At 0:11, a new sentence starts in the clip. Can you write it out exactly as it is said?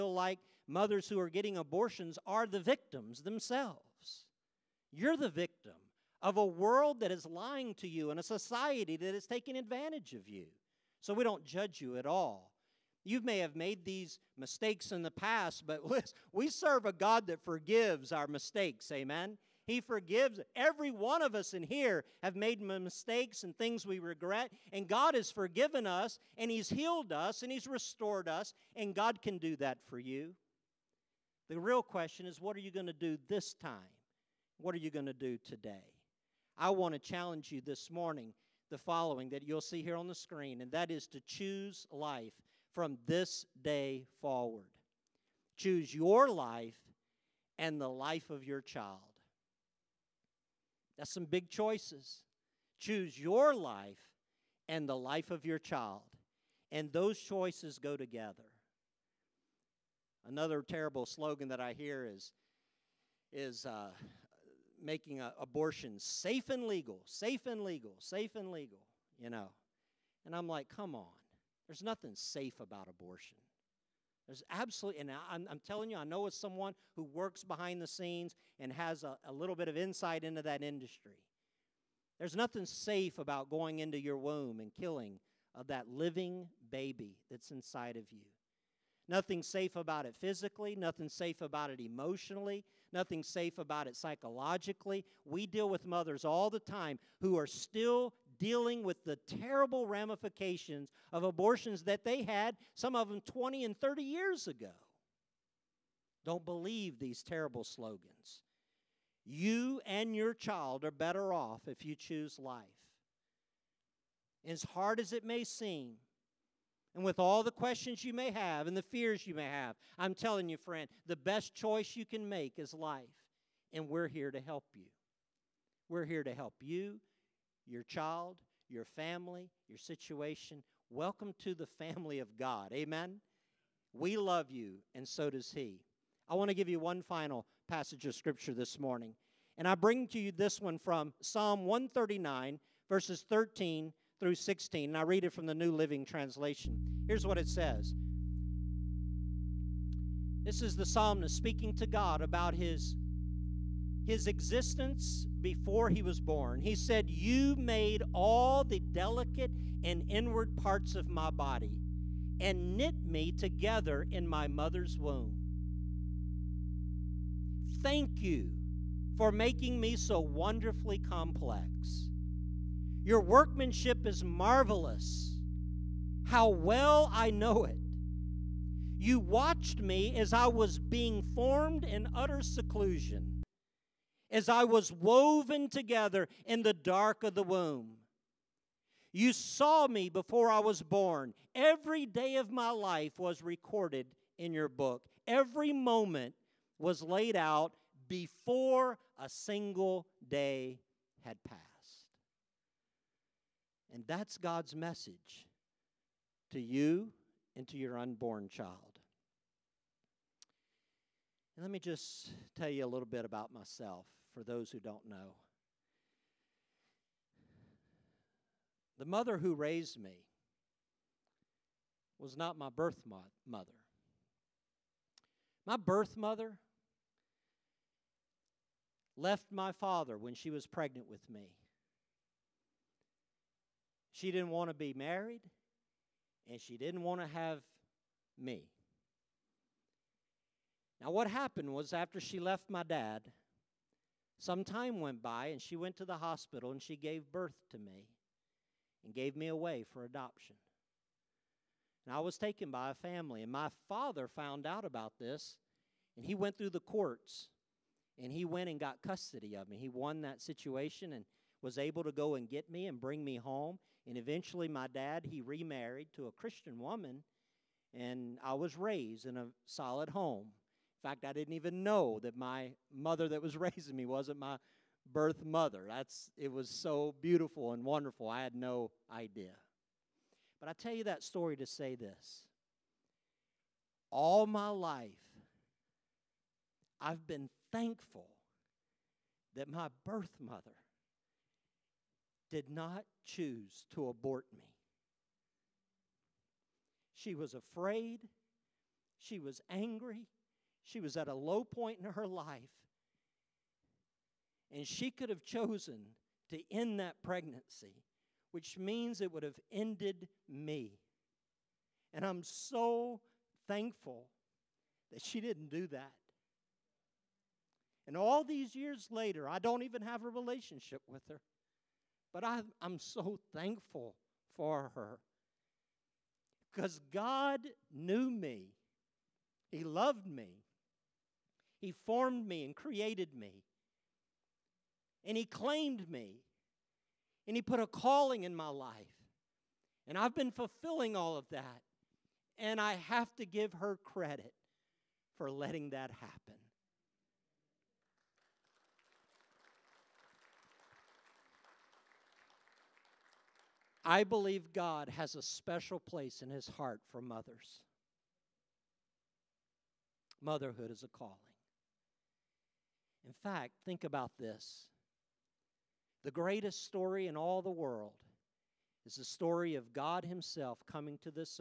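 So we don't judge you at all.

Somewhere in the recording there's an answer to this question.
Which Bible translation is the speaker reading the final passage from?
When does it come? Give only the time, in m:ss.
2:25.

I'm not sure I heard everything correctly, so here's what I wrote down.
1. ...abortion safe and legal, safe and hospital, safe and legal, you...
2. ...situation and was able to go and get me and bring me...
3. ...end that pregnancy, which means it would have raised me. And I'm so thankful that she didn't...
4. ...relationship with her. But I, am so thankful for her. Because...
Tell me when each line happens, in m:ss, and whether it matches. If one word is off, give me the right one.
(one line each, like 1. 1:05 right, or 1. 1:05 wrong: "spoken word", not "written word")
1. 1:05 wrong: "legal", not "hospital"
2. 4:20 right
3. 5:06 wrong: "ended", not "raised"
4. 5:20 right.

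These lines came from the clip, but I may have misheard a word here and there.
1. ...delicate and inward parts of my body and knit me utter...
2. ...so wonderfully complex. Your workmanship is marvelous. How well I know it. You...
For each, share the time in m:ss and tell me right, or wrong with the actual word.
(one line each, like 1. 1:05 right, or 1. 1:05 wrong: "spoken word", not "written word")
1. 2:38 wrong: "together", not "utter"
2. 2:49 right.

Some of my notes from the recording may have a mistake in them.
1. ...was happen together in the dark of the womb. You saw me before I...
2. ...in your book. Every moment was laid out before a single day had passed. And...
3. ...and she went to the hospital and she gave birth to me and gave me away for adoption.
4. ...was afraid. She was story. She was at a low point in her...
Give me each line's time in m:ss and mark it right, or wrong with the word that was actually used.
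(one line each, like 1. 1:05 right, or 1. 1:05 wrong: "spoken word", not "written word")
1. 3:04 wrong: "woven", not "happen"
2. 3:14 right
3. 4:05 right
4. 4:57 wrong: "angry", not "story".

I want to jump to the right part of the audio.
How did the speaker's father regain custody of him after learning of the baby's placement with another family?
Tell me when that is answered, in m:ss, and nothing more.
4:16.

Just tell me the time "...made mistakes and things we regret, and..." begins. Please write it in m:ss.
0:22.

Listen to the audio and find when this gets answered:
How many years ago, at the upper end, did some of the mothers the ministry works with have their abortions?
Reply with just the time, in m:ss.
1:43.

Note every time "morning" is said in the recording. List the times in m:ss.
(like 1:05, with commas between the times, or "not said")
0:37, 2:18.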